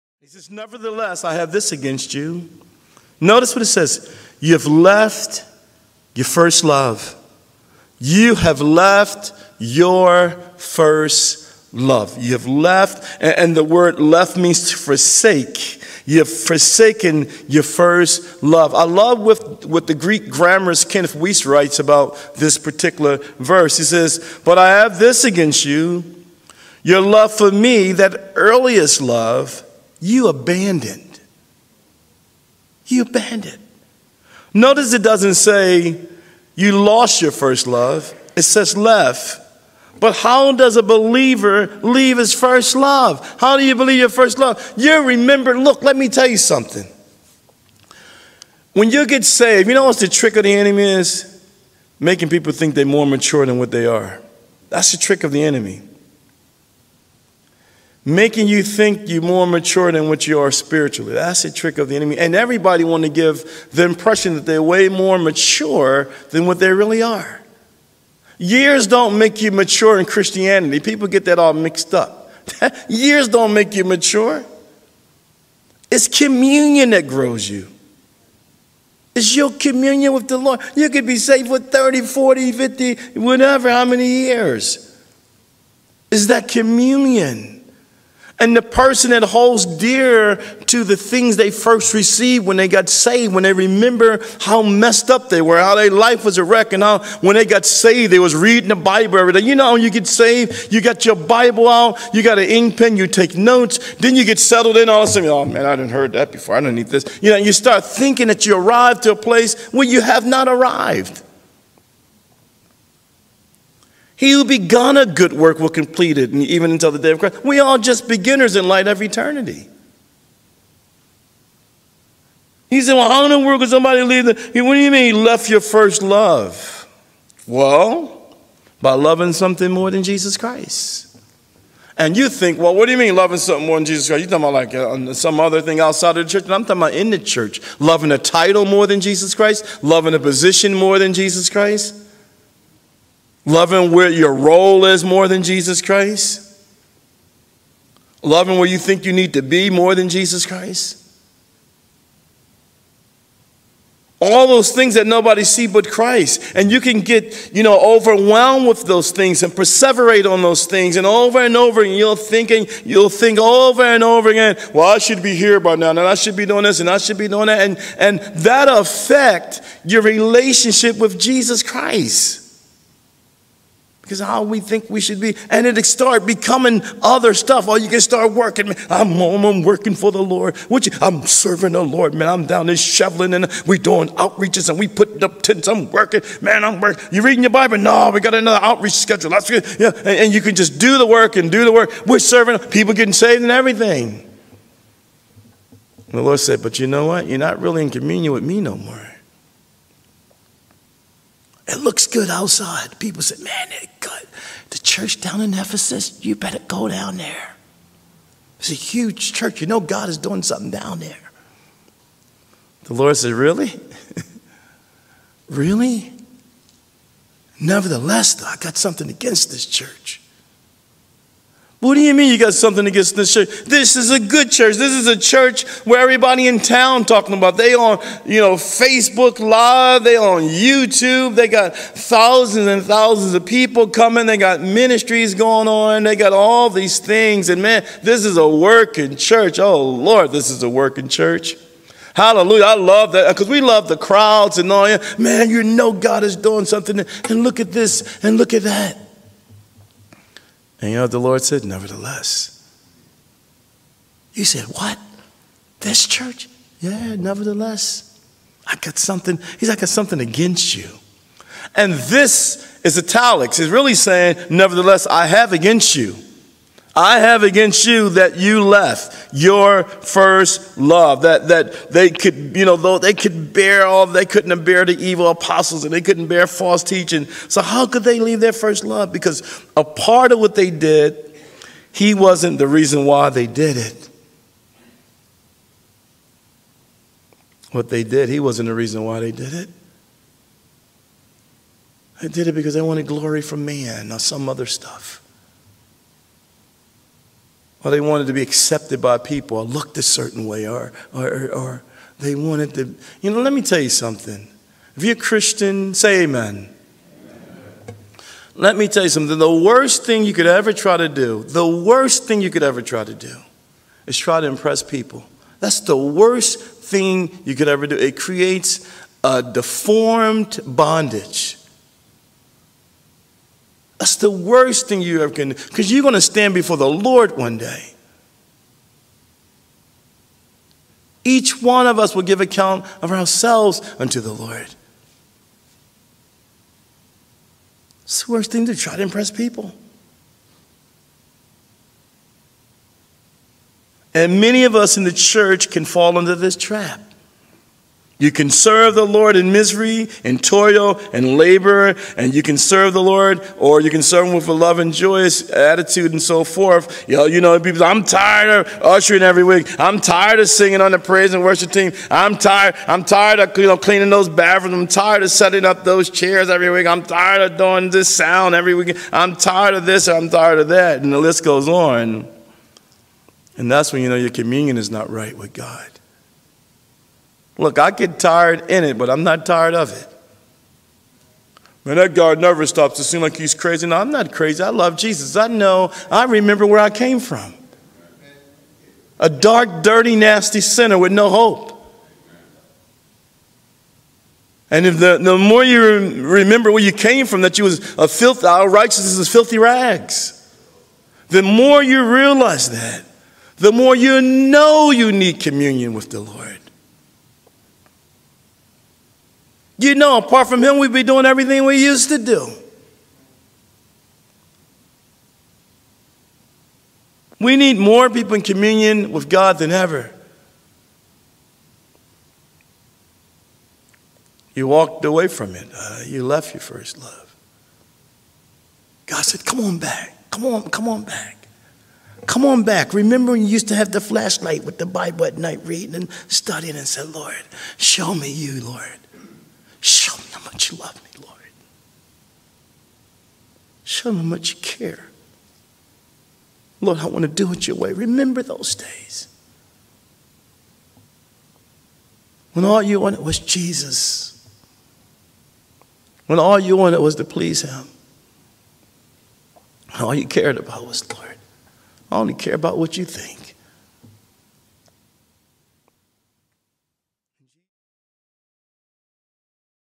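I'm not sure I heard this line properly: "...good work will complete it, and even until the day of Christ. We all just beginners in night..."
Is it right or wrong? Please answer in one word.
wrong.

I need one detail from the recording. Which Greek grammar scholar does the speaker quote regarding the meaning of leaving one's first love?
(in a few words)
Kenneth Wuest.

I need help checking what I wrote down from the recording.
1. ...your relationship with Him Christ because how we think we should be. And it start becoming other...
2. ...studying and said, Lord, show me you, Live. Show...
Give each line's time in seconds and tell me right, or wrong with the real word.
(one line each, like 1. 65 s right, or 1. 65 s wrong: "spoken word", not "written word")
1. 169 s wrong: "Jesus", not "Him"
2. 436 s wrong: "Lord", not "Live".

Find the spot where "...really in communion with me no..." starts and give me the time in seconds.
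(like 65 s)
197 s.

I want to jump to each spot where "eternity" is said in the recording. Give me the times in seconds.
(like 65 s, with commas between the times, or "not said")
119 s.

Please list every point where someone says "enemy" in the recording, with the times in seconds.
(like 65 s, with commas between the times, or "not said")
50 s, 55 s, 61 s.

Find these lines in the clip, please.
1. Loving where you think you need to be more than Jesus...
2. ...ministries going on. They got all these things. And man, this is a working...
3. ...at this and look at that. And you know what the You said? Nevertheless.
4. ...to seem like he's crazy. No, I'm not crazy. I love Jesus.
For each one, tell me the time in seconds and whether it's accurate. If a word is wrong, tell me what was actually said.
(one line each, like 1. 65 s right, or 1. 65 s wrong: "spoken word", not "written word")
1. 148 s right
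2. 234 s right
3. 247 s wrong: "Lord", not "You"
4. 382 s right.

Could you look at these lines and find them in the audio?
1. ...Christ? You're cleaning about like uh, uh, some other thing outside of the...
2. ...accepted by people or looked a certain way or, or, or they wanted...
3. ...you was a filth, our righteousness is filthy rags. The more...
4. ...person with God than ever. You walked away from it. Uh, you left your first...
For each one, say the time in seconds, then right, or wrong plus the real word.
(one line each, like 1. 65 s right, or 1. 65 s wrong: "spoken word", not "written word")
1. 134 s wrong: "talking", not "cleaning"
2. 298 s right
3. 397 s right
4. 418 s wrong: "communion", not "person".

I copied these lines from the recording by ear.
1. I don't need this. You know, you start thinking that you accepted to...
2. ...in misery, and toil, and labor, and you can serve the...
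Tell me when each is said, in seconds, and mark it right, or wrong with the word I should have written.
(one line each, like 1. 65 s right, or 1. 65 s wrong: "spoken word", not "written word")
1. 106 s wrong: "arrived", not "accepted"
2. 349 s right.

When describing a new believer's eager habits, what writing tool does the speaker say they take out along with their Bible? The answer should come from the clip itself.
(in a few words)
An ink pen.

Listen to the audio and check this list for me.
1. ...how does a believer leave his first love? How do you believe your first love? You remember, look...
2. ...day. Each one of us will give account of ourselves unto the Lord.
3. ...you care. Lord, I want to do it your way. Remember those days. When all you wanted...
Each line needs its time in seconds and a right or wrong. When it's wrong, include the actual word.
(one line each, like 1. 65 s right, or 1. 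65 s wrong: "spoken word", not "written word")
1. 40 s right
2. 327 s right
3. 444 s right.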